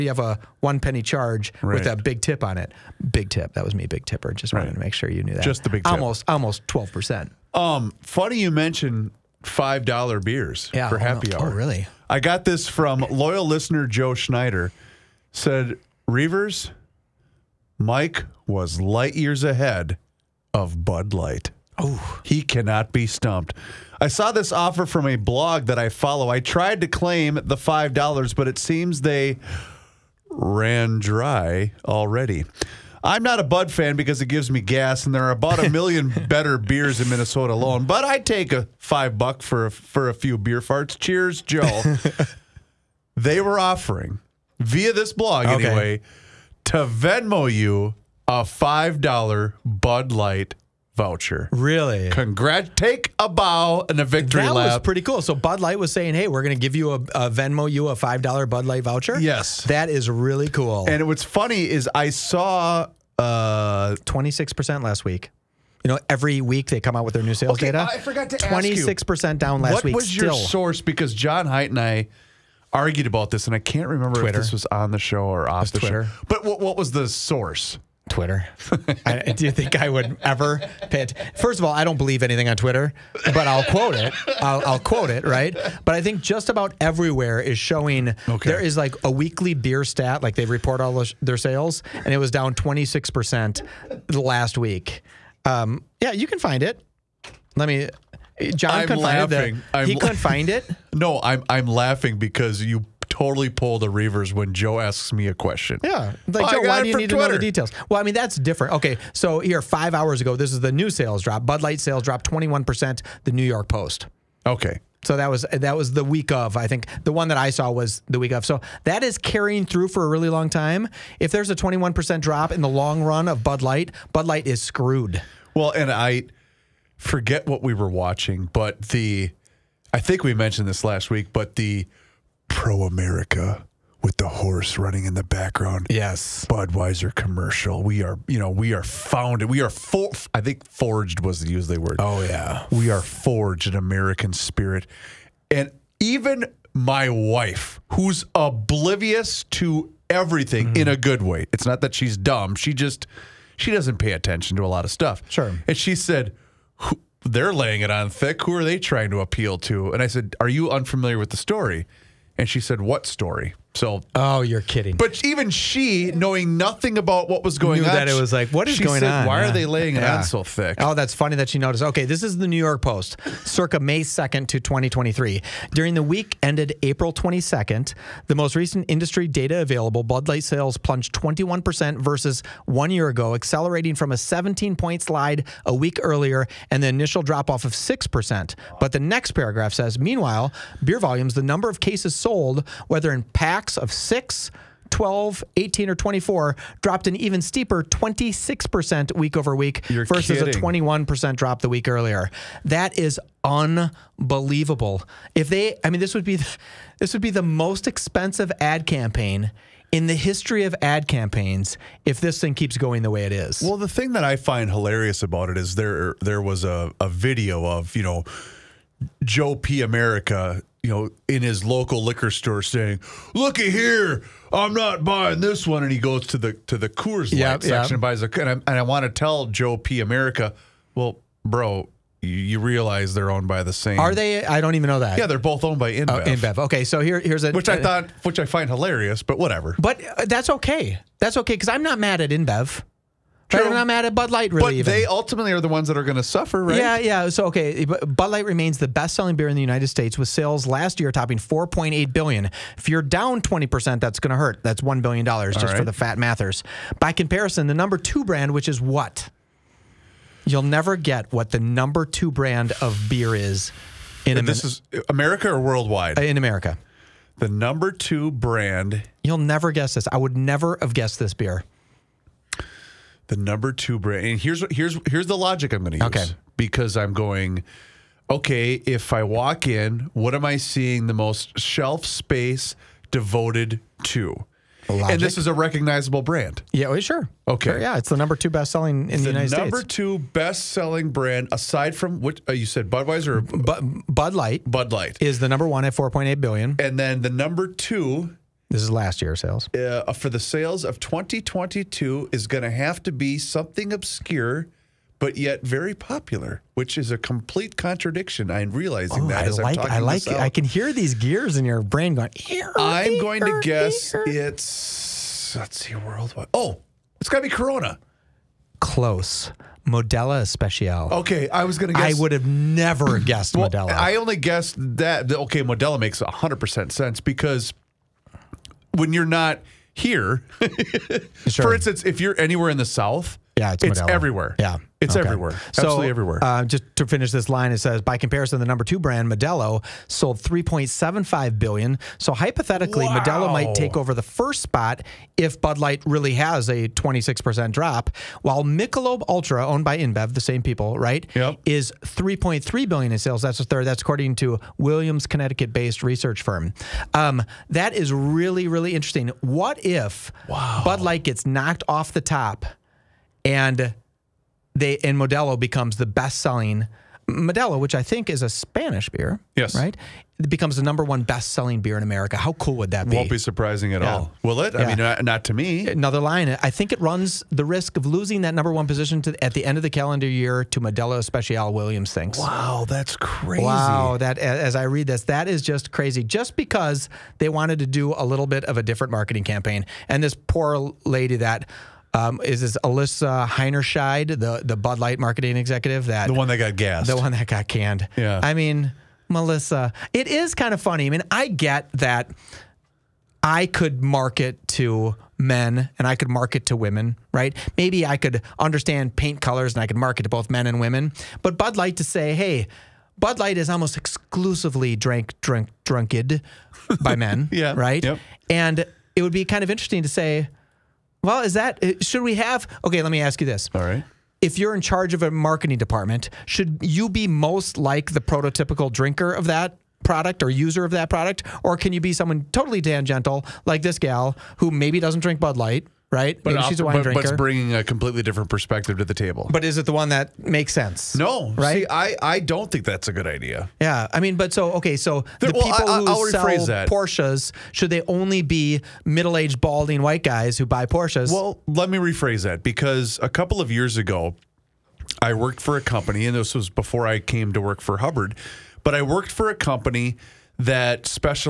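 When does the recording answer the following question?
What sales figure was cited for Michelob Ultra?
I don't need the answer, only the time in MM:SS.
05:52.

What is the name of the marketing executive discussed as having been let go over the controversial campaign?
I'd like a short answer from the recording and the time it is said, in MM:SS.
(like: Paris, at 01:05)
Alyssa Heinerscheid, at 06:32.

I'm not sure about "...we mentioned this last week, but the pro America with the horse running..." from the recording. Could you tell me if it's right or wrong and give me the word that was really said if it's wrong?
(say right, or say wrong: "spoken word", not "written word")
right.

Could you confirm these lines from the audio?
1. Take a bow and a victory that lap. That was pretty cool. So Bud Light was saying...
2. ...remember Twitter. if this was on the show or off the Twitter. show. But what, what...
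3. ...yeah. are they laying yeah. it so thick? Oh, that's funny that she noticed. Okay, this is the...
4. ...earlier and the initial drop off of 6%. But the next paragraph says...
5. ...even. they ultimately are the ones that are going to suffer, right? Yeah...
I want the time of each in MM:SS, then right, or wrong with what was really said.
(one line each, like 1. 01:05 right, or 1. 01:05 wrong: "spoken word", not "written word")
1. 00:52 right
2. 01:13 right
3. 02:49 right
4. 03:06 right
5. 04:04 right.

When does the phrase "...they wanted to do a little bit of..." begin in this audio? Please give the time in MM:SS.
06:27.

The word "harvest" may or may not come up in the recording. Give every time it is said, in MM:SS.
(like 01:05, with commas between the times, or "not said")
not said.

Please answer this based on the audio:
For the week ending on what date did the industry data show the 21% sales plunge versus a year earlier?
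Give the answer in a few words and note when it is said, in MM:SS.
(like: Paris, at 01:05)
April 22nd, at 02:56.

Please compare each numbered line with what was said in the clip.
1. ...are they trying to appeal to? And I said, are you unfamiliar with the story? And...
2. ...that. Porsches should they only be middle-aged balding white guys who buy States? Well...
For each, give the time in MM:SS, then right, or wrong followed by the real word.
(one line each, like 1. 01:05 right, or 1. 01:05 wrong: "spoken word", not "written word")
1. 02:38 right
2. 07:26 wrong: "Porsches", not "States".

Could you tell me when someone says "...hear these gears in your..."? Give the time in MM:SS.
05:10.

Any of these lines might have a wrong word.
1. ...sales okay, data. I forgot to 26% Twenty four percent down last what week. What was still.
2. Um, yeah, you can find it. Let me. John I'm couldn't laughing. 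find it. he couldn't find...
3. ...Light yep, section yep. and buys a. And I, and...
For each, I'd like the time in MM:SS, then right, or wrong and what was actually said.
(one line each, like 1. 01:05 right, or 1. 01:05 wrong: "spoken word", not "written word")
1. 01:07 wrong: "six", not "four"
2. 01:35 right
3. 03:47 right.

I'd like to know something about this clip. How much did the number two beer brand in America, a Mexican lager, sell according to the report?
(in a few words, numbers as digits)
3.75 billion.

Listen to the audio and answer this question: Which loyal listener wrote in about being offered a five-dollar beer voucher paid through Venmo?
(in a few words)
Joe Schneider.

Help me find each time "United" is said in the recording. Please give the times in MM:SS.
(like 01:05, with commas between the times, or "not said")
04:09, 04:49.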